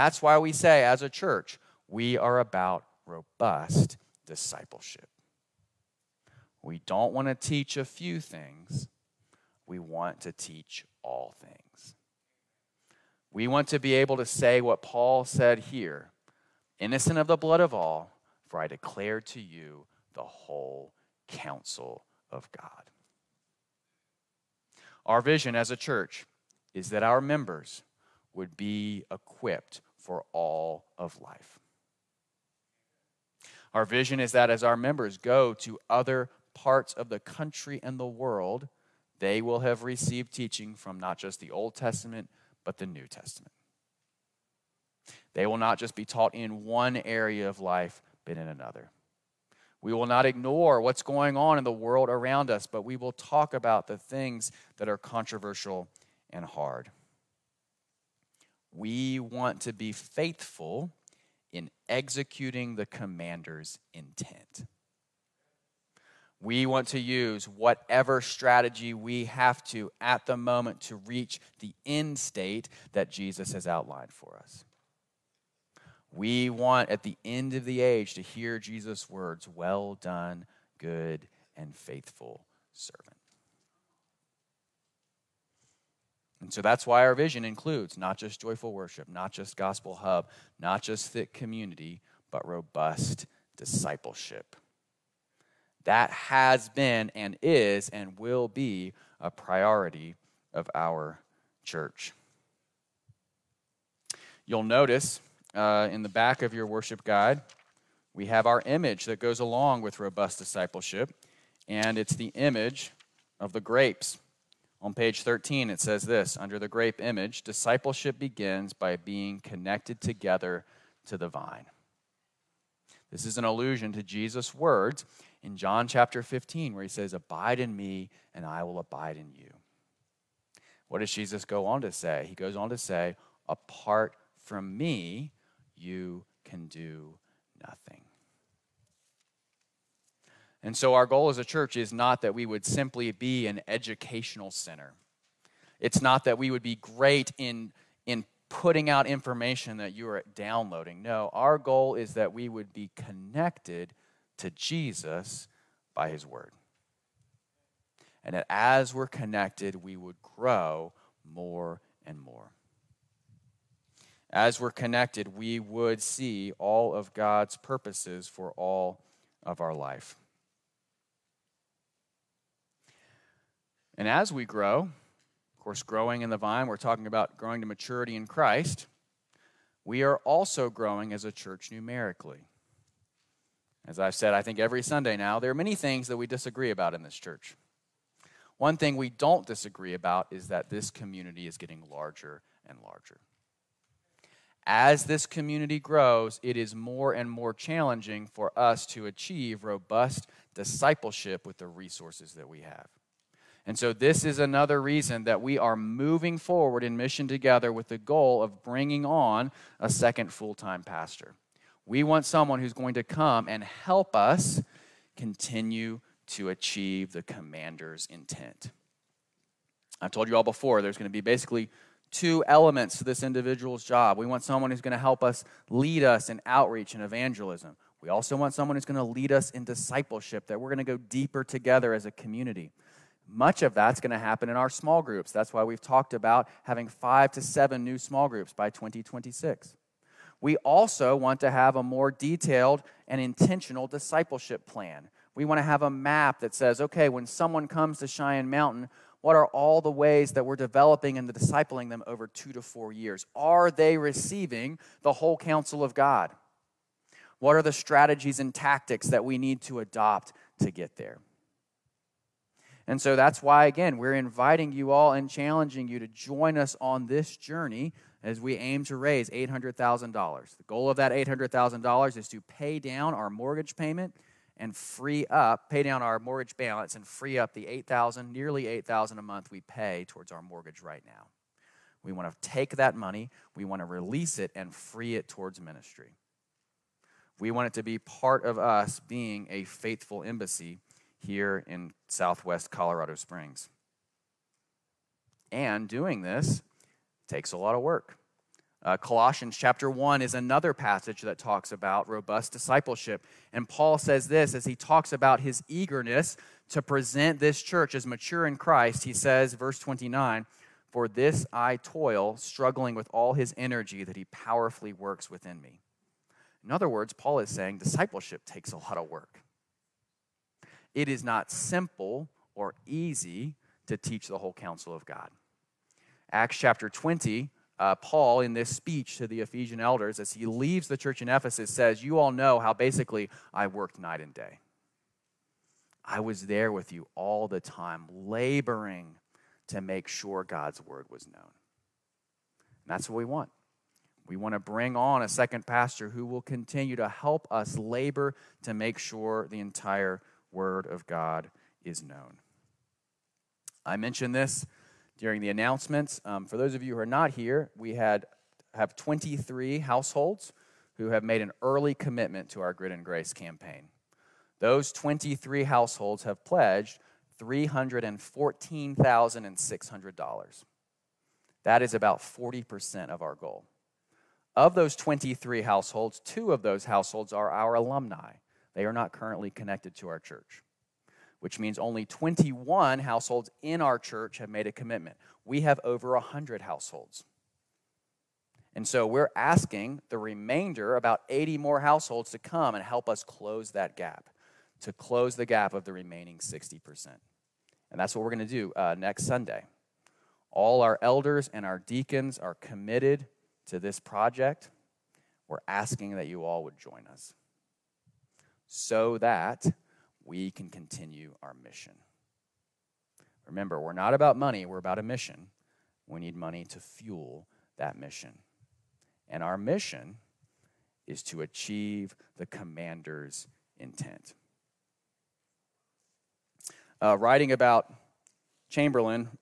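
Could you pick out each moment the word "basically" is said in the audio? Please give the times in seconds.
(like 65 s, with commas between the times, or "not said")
221 s, 332 s.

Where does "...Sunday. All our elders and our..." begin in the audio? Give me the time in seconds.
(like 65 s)
399 s.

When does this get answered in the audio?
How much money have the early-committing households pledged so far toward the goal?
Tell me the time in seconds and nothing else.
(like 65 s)
367 s.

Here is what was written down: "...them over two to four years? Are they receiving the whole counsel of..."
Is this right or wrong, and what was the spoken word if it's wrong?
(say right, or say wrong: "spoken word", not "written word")
right.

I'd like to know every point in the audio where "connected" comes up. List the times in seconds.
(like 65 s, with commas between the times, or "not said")
119 s, 152 s, 159 s, 164 s, 379 s.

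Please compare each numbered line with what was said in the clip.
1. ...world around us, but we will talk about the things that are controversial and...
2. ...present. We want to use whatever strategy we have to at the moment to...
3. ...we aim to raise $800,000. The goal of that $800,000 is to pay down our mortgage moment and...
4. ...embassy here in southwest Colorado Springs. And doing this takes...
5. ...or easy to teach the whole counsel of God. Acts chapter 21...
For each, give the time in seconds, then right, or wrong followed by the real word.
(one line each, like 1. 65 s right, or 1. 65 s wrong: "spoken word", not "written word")
1. 51 s right
2. 63 s wrong: "intent", not "present"
3. 268 s wrong: "payment", not "moment"
4. 290 s right
5. 322 s wrong: "20", not "21".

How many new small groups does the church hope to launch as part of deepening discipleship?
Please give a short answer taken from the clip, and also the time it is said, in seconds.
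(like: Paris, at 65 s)
5 to 7, at 236 s.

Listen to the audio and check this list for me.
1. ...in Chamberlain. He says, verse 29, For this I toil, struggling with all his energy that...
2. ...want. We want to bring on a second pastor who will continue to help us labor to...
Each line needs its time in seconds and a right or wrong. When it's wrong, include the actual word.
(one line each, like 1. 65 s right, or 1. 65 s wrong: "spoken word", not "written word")
1. 308 s wrong: "Christ", not "Chamberlain"
2. 343 s right.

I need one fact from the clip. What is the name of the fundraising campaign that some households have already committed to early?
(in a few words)
Grit and Grace.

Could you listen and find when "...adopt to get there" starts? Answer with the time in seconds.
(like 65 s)
259 s.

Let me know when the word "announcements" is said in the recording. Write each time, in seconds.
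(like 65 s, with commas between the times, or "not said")
355 s.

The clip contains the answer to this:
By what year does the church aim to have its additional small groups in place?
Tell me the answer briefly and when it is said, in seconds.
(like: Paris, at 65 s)
2026, at 238 s.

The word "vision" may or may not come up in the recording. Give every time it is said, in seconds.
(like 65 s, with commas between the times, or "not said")
25 s, 33 s, 87 s.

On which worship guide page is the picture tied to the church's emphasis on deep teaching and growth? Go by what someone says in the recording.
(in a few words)
13.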